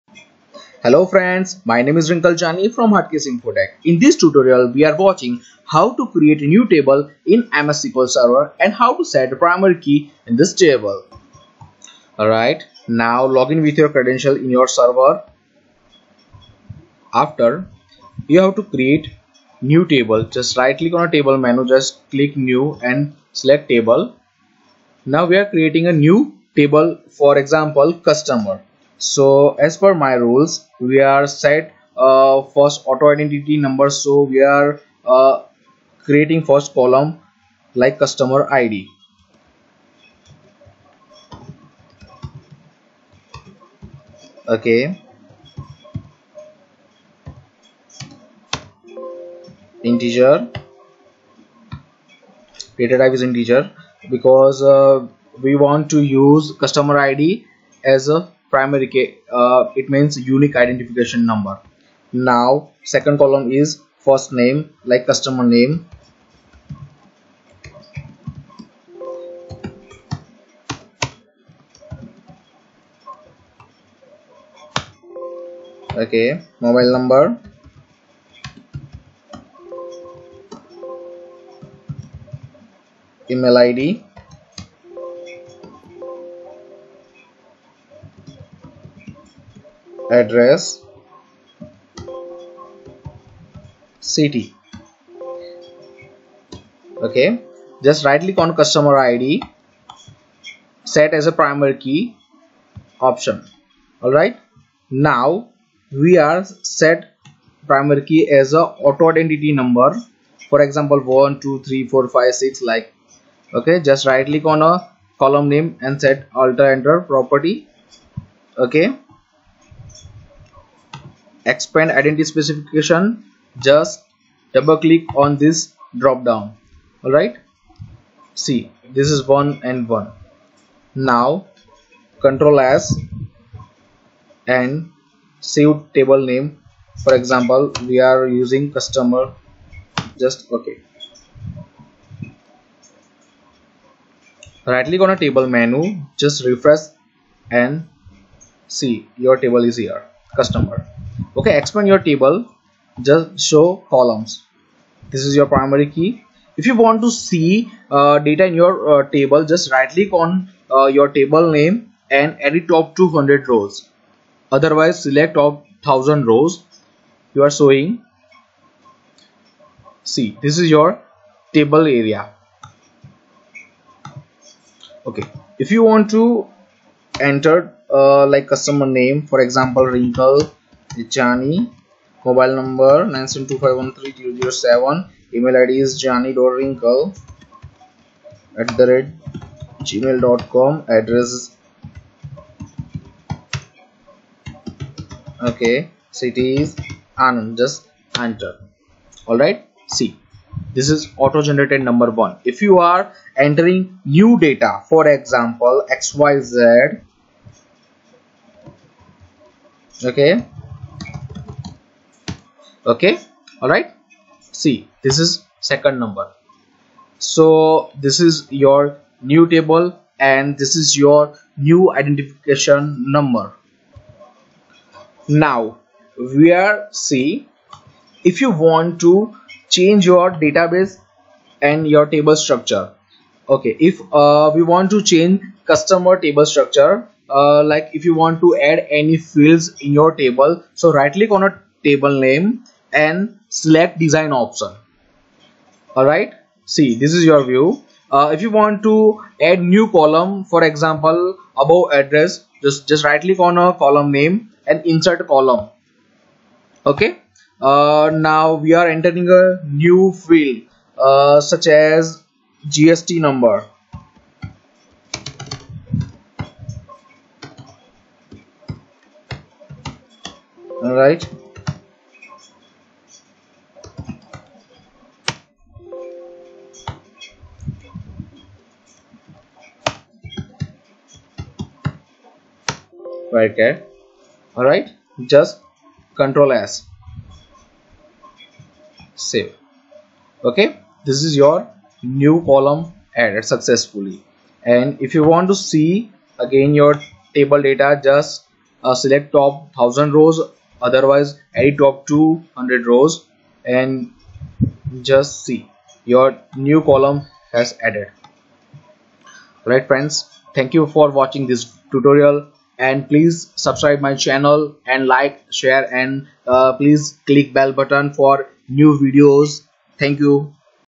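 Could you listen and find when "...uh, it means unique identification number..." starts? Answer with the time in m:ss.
0:59.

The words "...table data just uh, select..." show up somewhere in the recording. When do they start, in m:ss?
4:57.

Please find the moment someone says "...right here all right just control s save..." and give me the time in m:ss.
4:43.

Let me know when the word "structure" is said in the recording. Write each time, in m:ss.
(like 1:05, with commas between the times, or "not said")
3:52, 3:56.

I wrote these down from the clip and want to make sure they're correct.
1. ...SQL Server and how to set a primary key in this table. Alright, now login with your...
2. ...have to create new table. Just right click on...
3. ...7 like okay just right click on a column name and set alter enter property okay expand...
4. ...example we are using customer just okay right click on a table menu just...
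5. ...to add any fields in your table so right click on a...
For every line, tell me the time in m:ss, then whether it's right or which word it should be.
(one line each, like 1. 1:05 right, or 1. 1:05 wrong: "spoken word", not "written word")
1. 0:07 right
2. 0:18 right
3. 1:52 wrong: "6", not "7"
4. 2:17 right
5. 3:58 right.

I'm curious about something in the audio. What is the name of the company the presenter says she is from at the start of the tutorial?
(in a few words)
Hatkesh Infotech.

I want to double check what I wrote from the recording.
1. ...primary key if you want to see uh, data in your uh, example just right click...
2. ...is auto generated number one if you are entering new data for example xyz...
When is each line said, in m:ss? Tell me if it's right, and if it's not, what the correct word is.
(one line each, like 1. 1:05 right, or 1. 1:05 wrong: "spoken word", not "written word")
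1. 2:35 wrong: "table", not "example"
2. 3:20 right.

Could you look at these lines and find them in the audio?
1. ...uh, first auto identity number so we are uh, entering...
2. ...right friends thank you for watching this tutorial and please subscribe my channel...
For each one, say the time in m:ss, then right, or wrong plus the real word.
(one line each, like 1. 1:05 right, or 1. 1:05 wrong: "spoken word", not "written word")
1. 0:31 wrong: "creating", not "entering"
2. 5:09 right.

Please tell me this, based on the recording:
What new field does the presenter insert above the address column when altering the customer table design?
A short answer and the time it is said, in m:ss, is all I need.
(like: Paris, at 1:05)
GST number, at 4:22.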